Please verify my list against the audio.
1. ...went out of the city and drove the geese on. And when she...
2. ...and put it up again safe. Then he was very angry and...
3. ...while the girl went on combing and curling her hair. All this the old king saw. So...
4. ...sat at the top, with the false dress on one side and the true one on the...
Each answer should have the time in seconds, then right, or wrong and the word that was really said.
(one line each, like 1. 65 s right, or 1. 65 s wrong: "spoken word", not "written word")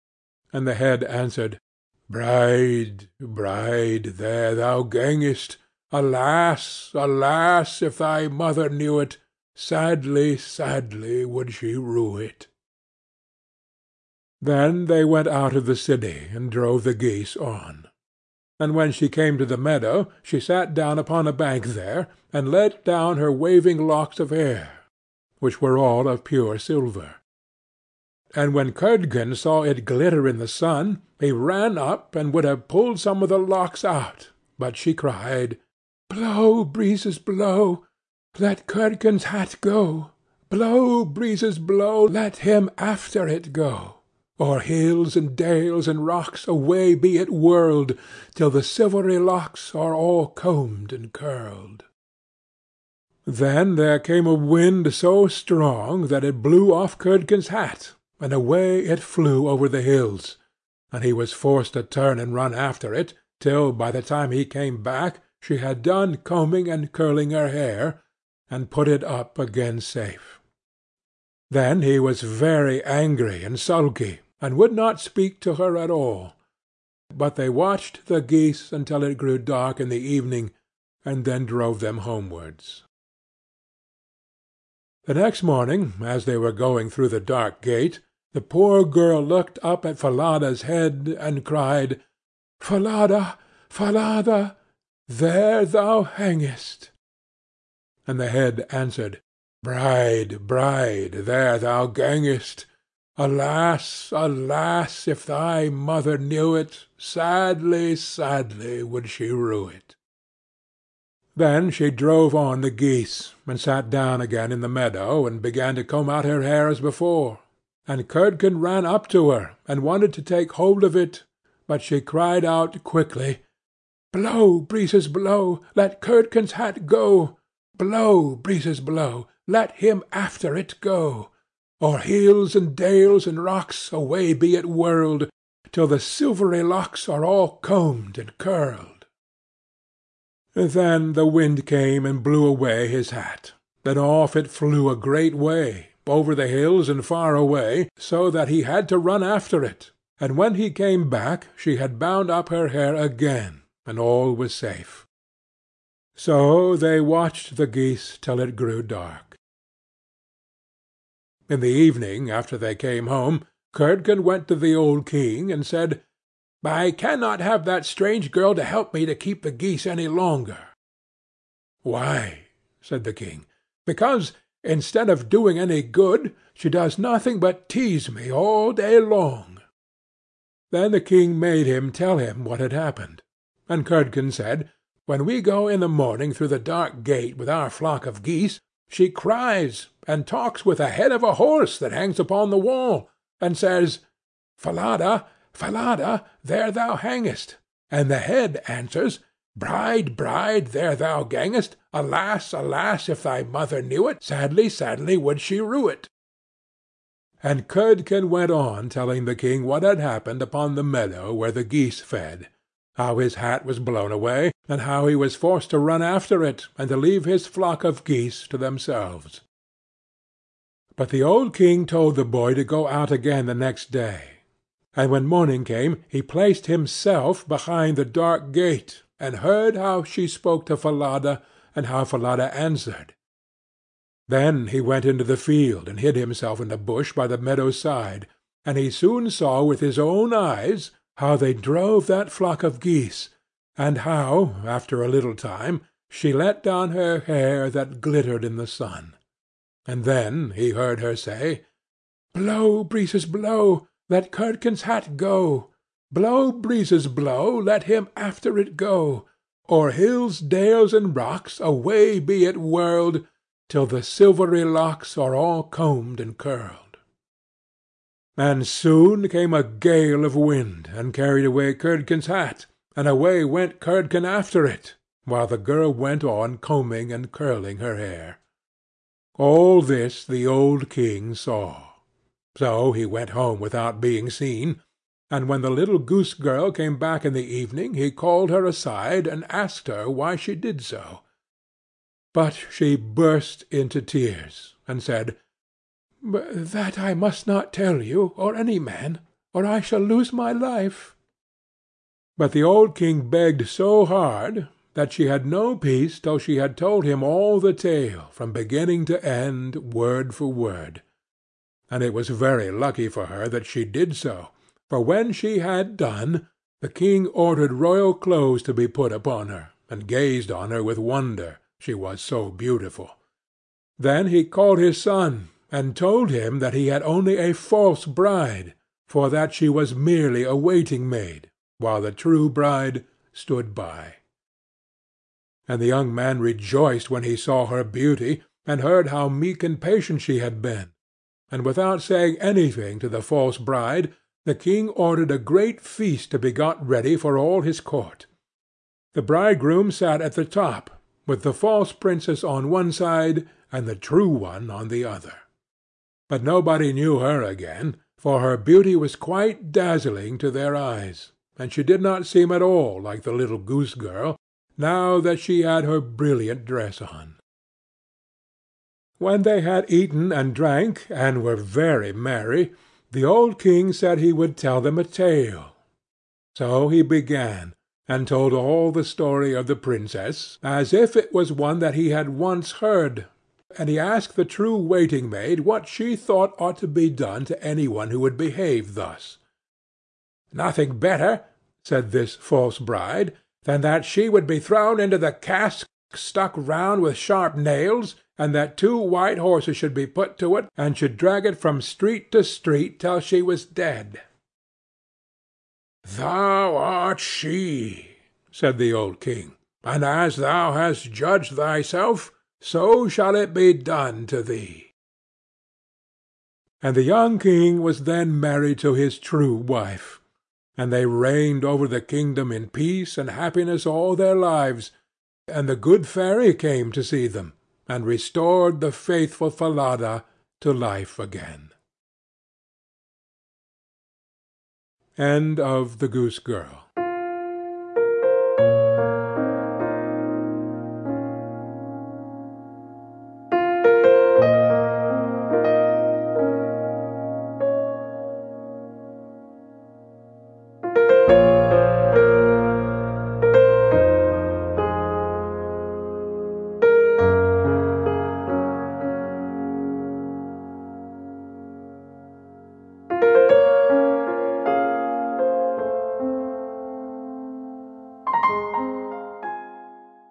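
1. 15 s right
2. 68 s right
3. 275 s right
4. 349 s wrong: "princess", not "dress".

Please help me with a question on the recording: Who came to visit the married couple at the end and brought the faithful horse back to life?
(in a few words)
The good fairy.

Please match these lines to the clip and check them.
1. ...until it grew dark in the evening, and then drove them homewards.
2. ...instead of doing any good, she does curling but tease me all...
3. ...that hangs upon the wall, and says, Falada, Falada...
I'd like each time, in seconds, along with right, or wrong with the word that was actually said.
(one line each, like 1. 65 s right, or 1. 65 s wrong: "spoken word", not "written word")
1. 78 s right
2. 174 s wrong: "nothing", not "curling"
3. 191 s right.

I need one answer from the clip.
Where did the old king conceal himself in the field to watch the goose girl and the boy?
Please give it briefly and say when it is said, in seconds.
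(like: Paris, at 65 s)
In a bush, at 236 s.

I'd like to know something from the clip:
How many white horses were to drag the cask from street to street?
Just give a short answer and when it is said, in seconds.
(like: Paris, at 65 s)
2, at 398 s.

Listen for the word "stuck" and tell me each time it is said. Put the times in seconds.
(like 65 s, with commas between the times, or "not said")
396 s.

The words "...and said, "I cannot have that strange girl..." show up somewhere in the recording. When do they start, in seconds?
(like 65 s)
165 s.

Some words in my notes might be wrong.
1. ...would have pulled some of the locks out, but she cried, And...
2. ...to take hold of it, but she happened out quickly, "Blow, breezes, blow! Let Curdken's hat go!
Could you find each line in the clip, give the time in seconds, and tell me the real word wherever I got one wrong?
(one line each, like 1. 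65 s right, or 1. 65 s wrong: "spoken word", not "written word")
1. 32 s wrong: "Blow", not "And"
2. 120 s wrong: "cried", not "happened".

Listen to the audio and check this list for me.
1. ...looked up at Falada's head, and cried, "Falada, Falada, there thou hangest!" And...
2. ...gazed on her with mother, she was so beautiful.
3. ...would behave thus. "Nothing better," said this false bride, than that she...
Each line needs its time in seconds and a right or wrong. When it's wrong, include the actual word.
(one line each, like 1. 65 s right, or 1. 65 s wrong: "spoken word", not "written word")
1. 89 s right
2. 320 s wrong: "wonder", not "mother"
3. 388 s right.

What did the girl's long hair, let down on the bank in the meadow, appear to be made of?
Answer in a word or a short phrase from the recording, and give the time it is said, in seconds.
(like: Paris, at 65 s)
Pure silver, at 26 s.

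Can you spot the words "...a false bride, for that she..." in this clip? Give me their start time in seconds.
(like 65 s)
327 s.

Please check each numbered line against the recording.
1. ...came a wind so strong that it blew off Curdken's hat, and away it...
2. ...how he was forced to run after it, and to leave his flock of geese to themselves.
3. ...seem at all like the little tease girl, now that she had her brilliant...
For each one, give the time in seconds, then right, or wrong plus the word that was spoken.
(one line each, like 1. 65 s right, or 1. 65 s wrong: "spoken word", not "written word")
1. 54 s right
2. 214 s right
3. 362 s wrong: "goose", not "tease".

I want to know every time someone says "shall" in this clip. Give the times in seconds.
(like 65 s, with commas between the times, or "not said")
299 s, 413 s.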